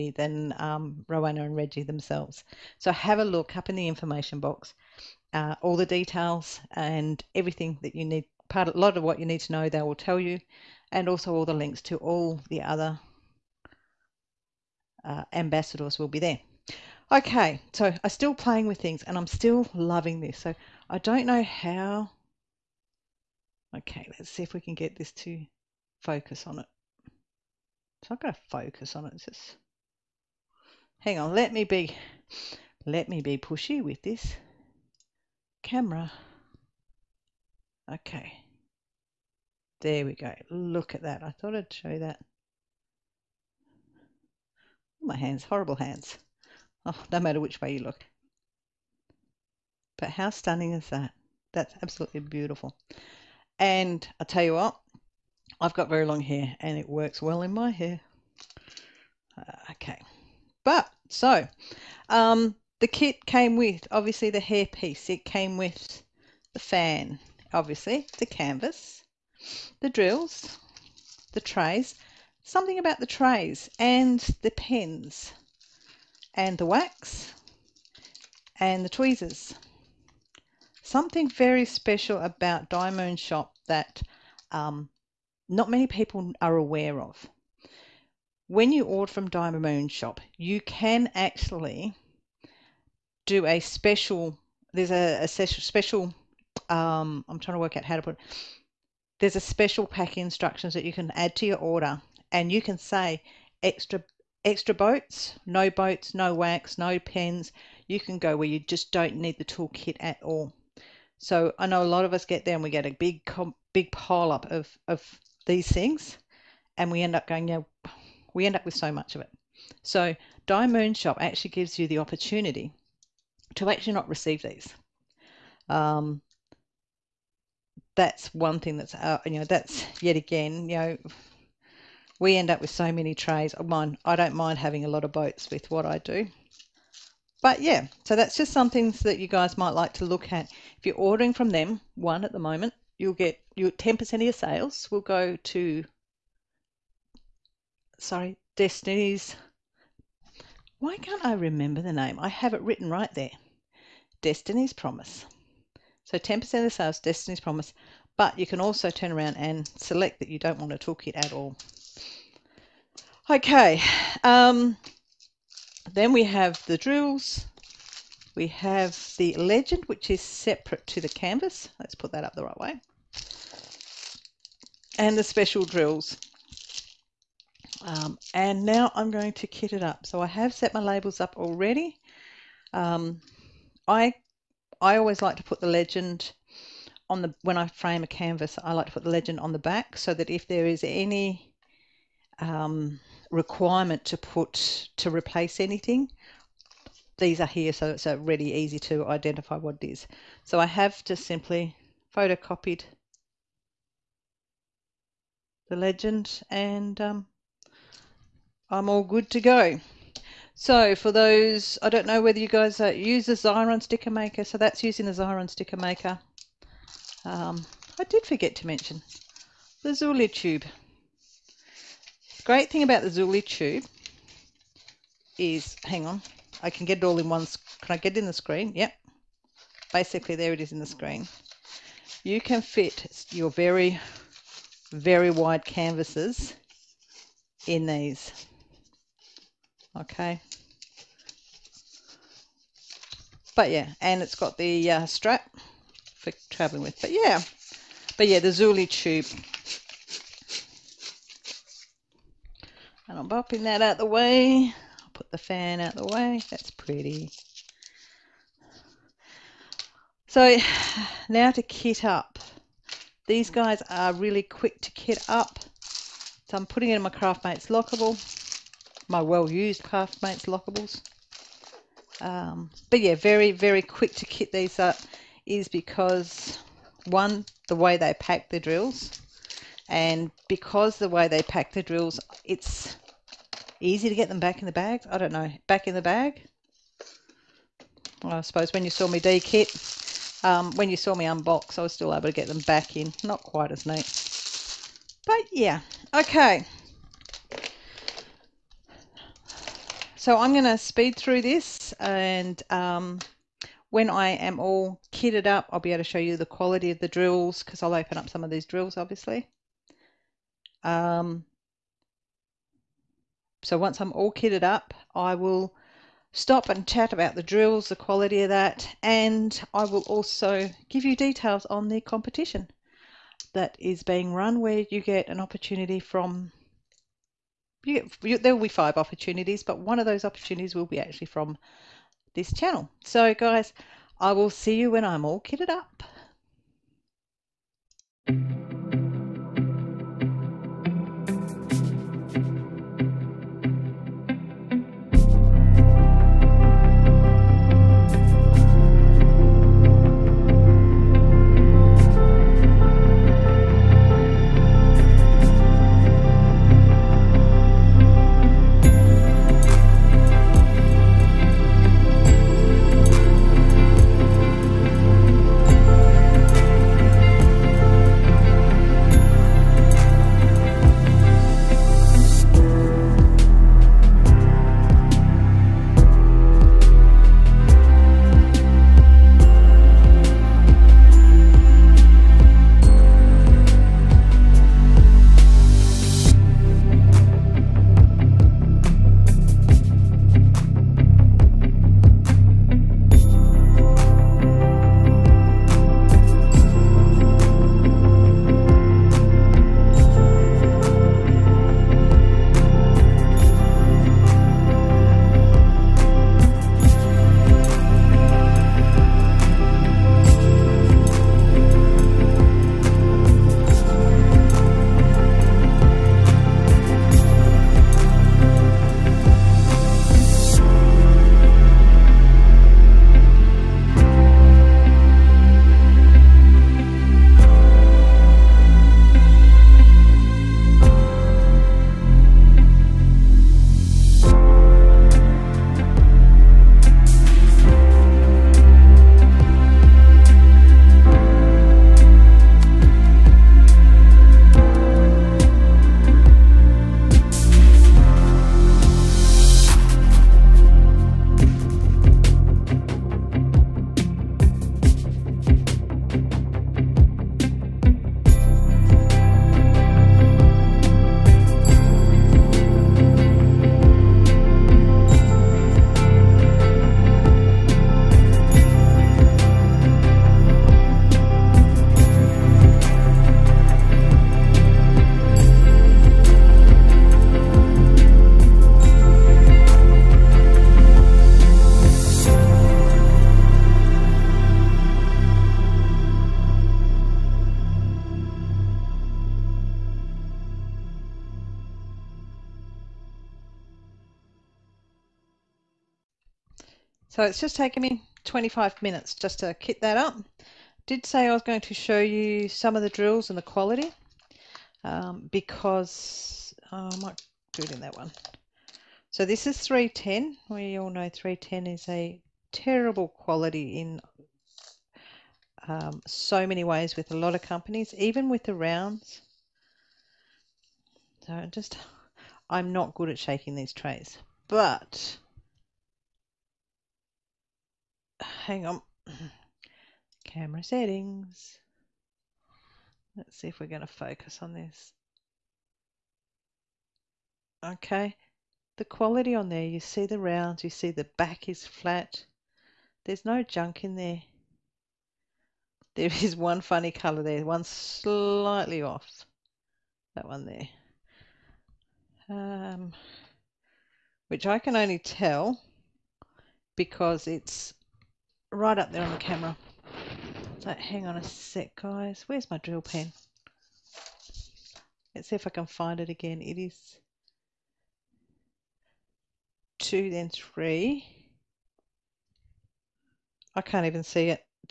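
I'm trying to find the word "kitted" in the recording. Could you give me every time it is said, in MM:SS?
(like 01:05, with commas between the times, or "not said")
05:05, 05:14, 05:35.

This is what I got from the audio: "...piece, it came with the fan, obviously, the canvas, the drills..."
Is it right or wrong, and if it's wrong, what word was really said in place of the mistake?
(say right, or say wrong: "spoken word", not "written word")
right.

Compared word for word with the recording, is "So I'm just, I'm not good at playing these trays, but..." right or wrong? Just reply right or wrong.
wrong.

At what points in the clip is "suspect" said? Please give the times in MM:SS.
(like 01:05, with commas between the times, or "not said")
not said.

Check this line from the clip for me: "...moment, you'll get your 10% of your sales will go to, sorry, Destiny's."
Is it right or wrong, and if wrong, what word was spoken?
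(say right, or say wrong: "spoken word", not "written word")
right.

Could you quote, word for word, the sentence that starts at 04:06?
But yeah, but yeah, the Zuli tube And I'm bopping that out the way.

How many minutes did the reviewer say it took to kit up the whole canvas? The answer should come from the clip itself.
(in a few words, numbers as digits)
25.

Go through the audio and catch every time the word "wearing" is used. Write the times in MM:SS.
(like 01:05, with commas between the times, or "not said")
not said.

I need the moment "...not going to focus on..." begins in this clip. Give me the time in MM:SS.
00:28.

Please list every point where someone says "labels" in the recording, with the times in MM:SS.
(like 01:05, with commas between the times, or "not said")
03:00.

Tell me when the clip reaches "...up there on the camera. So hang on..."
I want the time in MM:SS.
09:18.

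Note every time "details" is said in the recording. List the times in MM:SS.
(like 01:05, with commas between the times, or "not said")
00:05, 05:21.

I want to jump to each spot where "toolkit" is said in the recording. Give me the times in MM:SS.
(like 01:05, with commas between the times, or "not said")
01:49, 02:40.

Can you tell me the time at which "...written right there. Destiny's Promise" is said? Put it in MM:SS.
02:32.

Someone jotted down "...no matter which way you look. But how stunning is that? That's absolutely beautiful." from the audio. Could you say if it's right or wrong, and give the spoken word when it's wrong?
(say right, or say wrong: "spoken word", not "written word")
right.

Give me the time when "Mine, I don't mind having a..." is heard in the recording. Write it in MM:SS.
02:13.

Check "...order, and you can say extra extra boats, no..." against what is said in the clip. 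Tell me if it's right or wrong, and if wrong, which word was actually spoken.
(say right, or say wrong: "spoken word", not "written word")
right.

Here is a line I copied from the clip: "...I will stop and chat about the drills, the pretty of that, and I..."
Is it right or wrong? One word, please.
wrong.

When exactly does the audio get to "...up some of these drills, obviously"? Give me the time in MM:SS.
05:08.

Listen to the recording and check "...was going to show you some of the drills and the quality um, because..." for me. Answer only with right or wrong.
right.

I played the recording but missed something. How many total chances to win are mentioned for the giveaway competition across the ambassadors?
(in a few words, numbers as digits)
5.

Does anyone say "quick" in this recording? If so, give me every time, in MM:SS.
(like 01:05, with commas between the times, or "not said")
04:24, 04:33.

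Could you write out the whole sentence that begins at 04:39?
And because the way they pack the drills, it's easy to get them back in the bag.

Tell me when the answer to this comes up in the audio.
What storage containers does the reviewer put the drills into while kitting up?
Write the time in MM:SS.
04:29.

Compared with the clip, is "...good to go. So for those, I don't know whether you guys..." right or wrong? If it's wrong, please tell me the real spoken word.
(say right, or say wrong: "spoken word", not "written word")
right.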